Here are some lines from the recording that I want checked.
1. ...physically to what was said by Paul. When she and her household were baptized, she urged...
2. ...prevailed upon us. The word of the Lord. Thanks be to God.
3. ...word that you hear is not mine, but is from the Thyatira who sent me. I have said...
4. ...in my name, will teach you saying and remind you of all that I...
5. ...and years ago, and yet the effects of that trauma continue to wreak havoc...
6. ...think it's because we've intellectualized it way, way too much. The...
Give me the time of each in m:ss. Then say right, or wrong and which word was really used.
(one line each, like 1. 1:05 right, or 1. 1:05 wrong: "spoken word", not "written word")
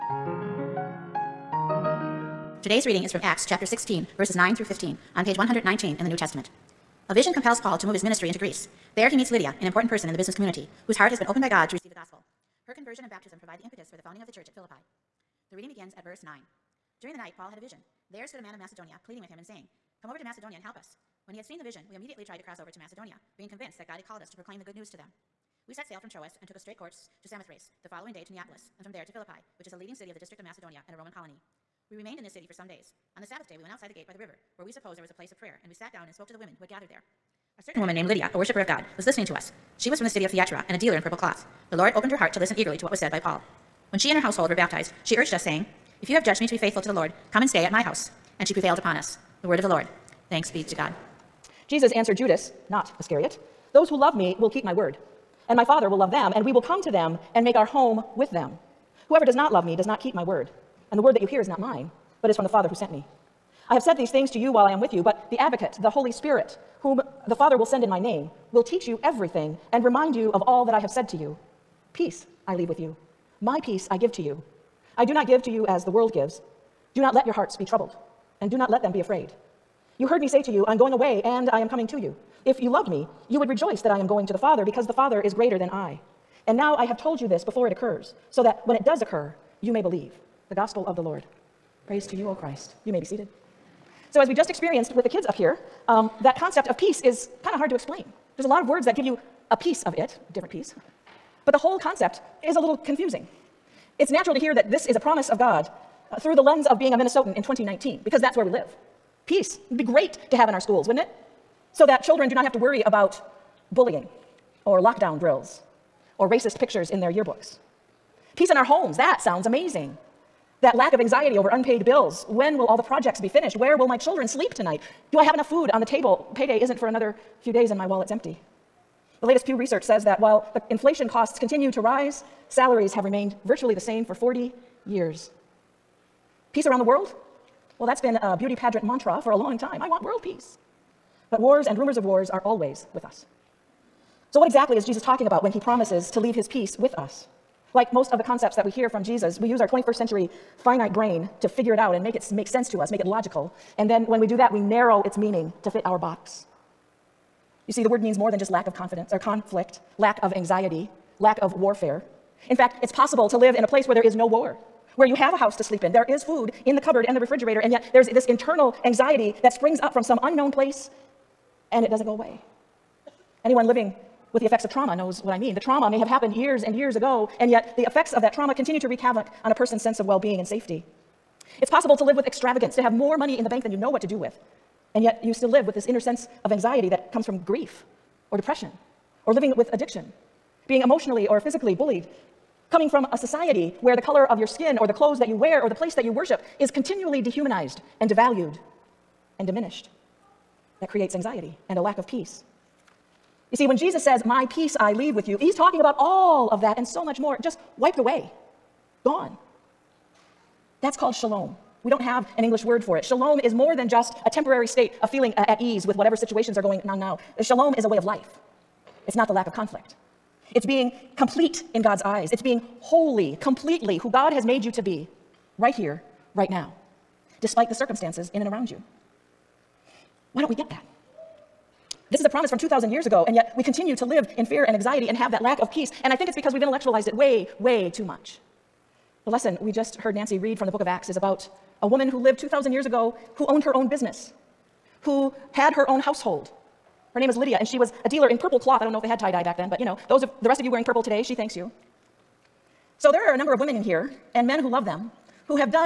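1. 0:42 wrong: "eagerly", not "physically"
2. 0:48 right
3. 1:01 wrong: "Father", not "Thyatira"
4. 1:07 wrong: "everything", not "saying"
5. 2:56 right
6. 3:56 right.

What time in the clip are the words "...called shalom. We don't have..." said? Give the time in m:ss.
3:30.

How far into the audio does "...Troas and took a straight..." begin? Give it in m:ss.
0:26.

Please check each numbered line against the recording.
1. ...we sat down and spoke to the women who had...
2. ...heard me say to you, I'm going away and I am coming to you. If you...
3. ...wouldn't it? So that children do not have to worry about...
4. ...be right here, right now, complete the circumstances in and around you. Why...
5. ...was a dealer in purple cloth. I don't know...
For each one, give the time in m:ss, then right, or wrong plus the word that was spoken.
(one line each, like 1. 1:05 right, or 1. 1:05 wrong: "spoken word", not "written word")
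1. 0:35 right
2. 1:20 right
3. 1:50 right
4. 3:44 wrong: "despite", not "complete"
5. 4:07 right.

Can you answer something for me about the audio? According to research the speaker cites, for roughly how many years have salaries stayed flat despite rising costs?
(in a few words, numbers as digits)
40.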